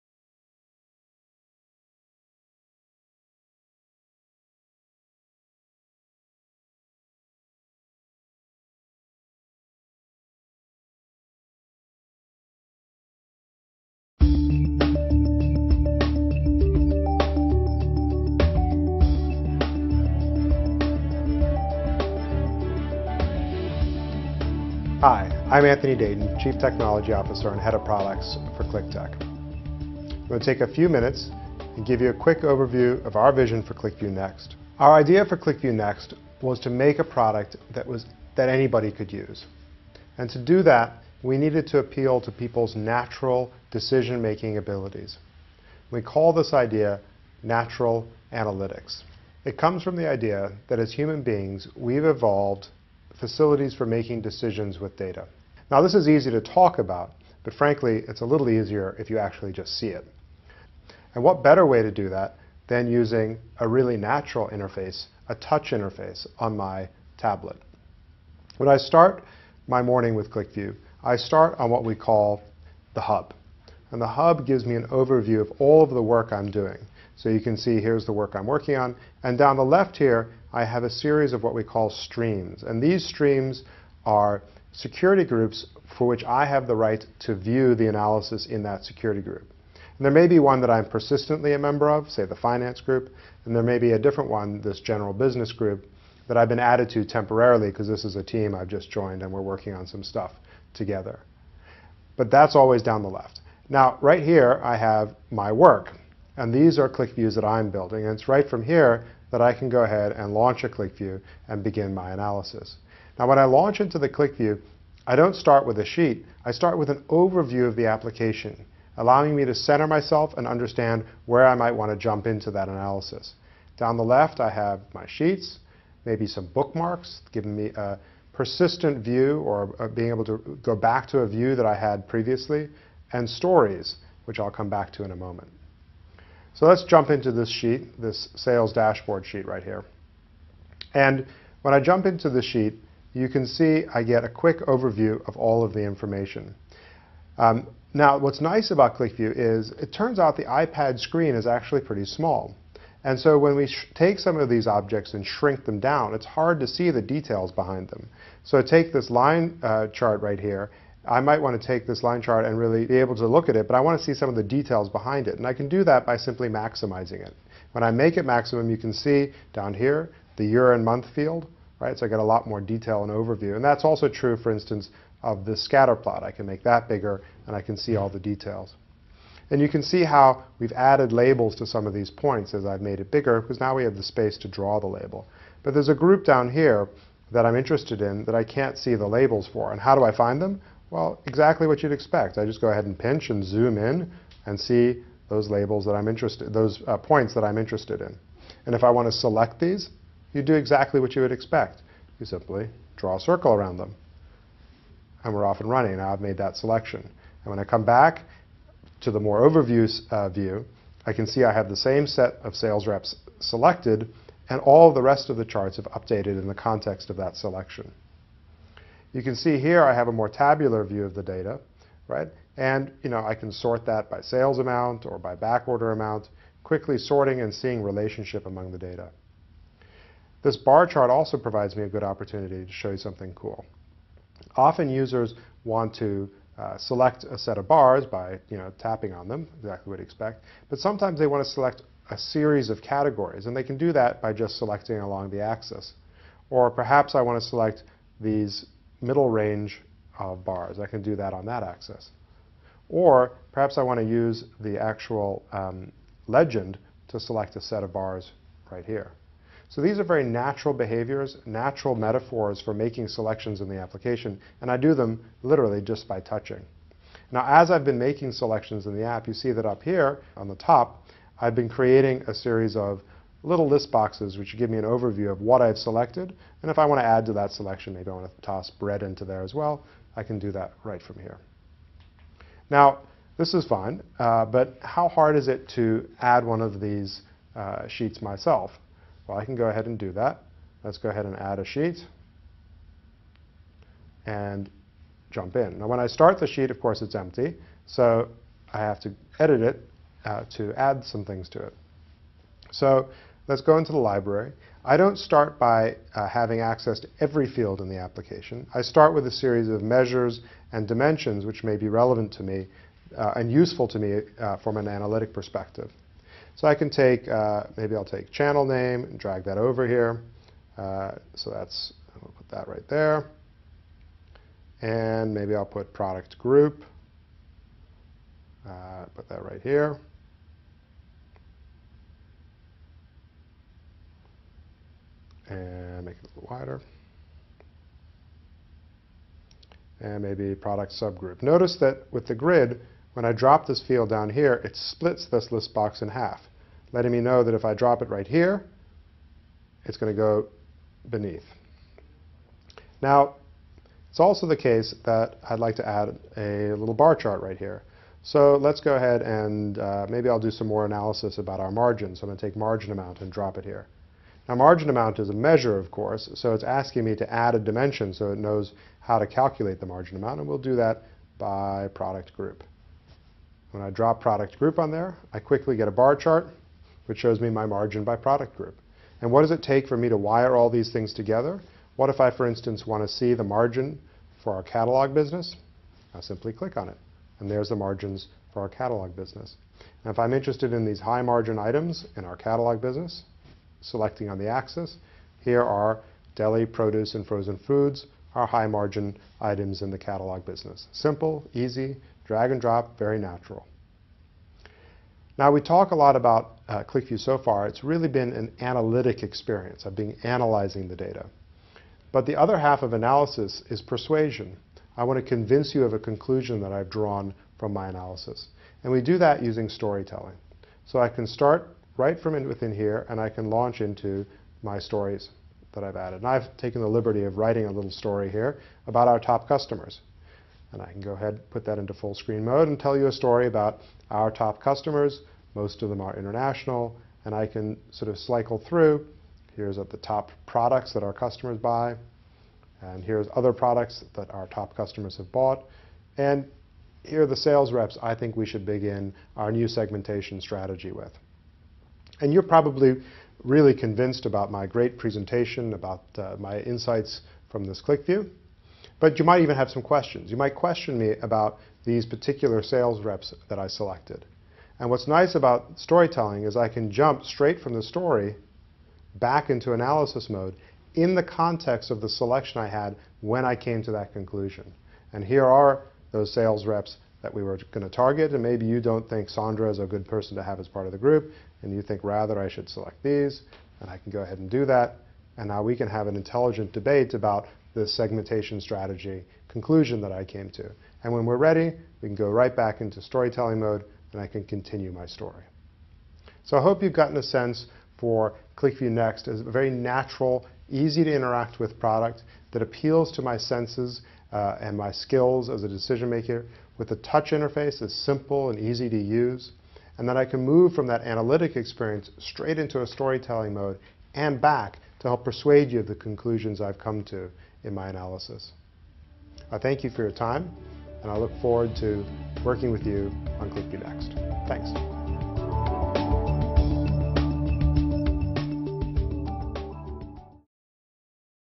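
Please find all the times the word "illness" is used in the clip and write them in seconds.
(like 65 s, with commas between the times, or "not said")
not said.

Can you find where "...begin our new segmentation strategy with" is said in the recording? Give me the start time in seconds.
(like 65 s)
448 s.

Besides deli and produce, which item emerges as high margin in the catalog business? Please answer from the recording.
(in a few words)
frozen foods.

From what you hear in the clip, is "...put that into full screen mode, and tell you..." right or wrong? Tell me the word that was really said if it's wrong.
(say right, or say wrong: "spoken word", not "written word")
right.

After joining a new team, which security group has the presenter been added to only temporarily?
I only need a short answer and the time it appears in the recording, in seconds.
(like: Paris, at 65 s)
general business group, at 94 s.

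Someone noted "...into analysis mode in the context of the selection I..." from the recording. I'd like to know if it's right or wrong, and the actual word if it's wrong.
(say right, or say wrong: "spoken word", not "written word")
right.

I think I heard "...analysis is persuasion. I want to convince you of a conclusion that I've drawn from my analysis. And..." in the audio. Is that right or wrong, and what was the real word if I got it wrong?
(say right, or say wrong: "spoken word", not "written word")
right.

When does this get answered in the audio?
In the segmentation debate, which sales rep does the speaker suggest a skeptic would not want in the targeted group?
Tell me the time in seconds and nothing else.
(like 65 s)
479 s.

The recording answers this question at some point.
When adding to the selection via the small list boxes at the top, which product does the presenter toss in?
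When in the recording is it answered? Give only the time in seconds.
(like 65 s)
278 s.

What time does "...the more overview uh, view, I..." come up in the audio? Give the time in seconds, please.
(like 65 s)
209 s.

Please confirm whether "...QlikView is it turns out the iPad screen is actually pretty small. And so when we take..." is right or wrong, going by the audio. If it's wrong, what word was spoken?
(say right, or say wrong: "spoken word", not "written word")
right.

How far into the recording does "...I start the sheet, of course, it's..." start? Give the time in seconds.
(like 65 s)
295 s.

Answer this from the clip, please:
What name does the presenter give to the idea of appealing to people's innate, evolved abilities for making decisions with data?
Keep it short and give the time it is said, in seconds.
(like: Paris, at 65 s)
natural analytics, at 47 s.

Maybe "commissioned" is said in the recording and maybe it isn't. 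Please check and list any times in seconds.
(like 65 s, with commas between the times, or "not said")
not said.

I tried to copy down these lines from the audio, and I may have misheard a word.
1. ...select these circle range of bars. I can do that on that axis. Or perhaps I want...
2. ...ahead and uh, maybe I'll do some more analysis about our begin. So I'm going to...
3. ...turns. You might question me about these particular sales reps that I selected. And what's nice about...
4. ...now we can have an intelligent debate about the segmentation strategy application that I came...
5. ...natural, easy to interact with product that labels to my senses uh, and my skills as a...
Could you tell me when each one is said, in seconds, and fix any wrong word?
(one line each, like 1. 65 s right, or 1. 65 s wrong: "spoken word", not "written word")
1. 247 s wrong: "middle", not "circle"
2. 358 s wrong: "margin", not "begin"
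3. 459 s wrong: "questions", not "turns"
4. 485 s wrong: "conclusion", not "application"
5. 499 s wrong: "appeals", not "labels".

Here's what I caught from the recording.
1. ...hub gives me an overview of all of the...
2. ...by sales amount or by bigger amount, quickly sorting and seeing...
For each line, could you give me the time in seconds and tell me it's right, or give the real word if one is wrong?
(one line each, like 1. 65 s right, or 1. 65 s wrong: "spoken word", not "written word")
1. 74 s right
2. 224 s wrong: "backorder", not "bigger".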